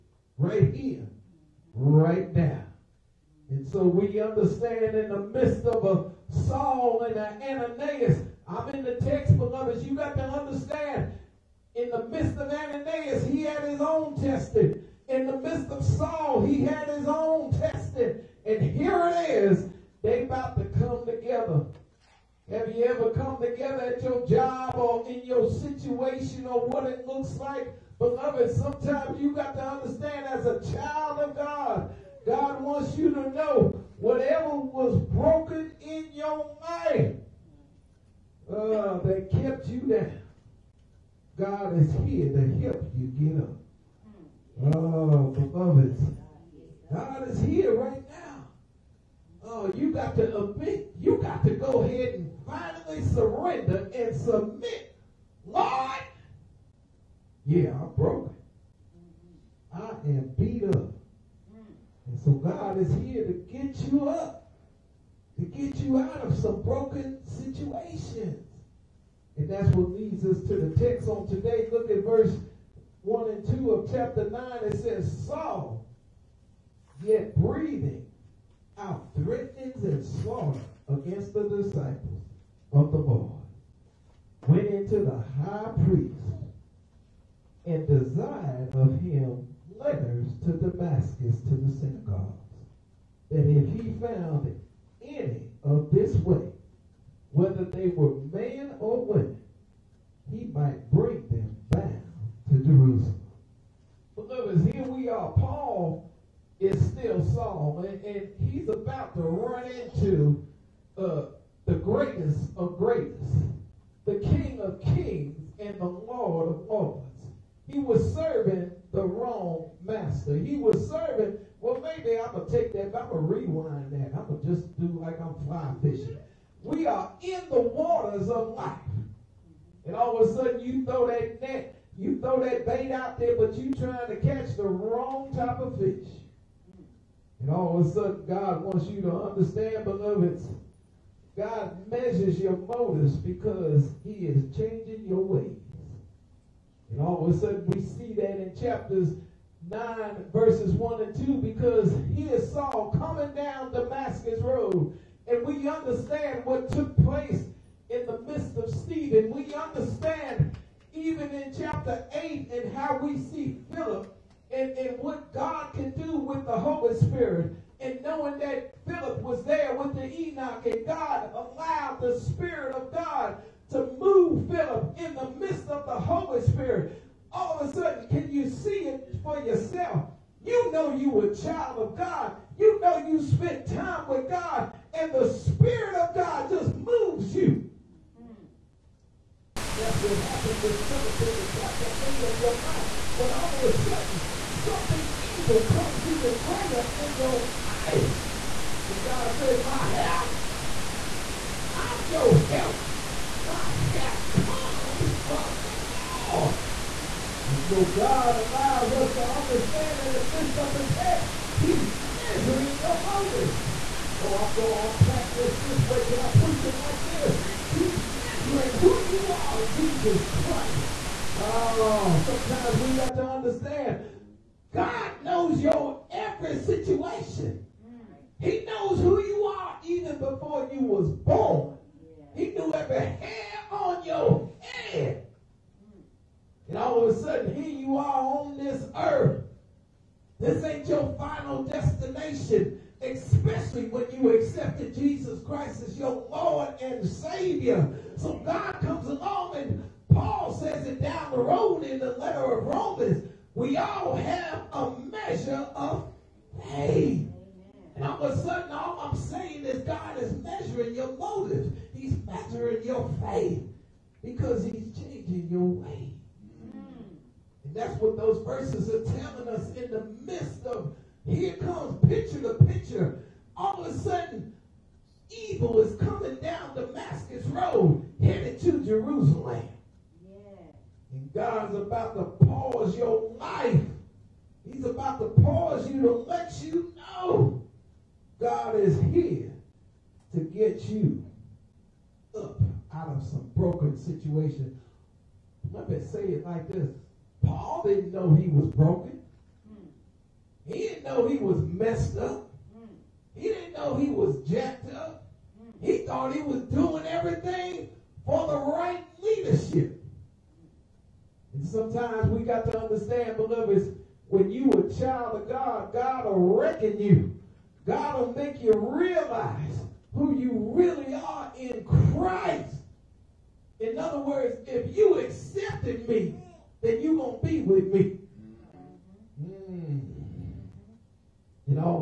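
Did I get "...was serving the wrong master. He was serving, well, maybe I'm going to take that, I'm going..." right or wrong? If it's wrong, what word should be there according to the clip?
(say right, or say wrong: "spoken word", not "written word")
right.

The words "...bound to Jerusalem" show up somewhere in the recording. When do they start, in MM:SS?
01:41.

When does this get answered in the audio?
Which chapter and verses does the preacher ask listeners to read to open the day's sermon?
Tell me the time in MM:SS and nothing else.
01:12.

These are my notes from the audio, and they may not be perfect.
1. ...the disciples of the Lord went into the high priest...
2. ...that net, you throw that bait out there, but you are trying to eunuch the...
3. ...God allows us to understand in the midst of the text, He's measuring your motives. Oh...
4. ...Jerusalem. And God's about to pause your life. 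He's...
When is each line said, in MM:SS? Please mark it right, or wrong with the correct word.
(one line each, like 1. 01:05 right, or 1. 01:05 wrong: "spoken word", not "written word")
1. 01:21 right
2. 02:11 wrong: "catch", not "eunuch"
3. 03:27 right
4. 04:38 right.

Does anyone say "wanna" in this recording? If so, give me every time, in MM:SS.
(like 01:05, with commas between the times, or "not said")
not said.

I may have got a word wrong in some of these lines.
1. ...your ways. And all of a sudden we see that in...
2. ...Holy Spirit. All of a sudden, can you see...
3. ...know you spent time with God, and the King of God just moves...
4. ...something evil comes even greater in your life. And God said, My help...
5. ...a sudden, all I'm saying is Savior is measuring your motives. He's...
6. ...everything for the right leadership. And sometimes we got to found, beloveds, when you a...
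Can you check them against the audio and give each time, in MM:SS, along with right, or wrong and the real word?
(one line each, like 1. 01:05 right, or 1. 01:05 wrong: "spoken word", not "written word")
1. 02:25 right
2. 02:55 right
3. 03:02 wrong: "Spirit", not "King"
4. 03:14 right
5. 04:18 wrong: "God", not "Savior"
6. 05:07 wrong: "understand", not "found".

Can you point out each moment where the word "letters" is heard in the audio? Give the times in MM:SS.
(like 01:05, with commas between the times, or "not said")
01:29, 04:12.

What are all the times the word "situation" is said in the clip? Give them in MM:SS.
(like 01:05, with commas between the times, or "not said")
00:25, 01:07, 03:46, 04:53.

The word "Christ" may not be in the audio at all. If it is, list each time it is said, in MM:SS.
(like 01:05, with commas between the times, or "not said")
03:40, 04:05, 05:22.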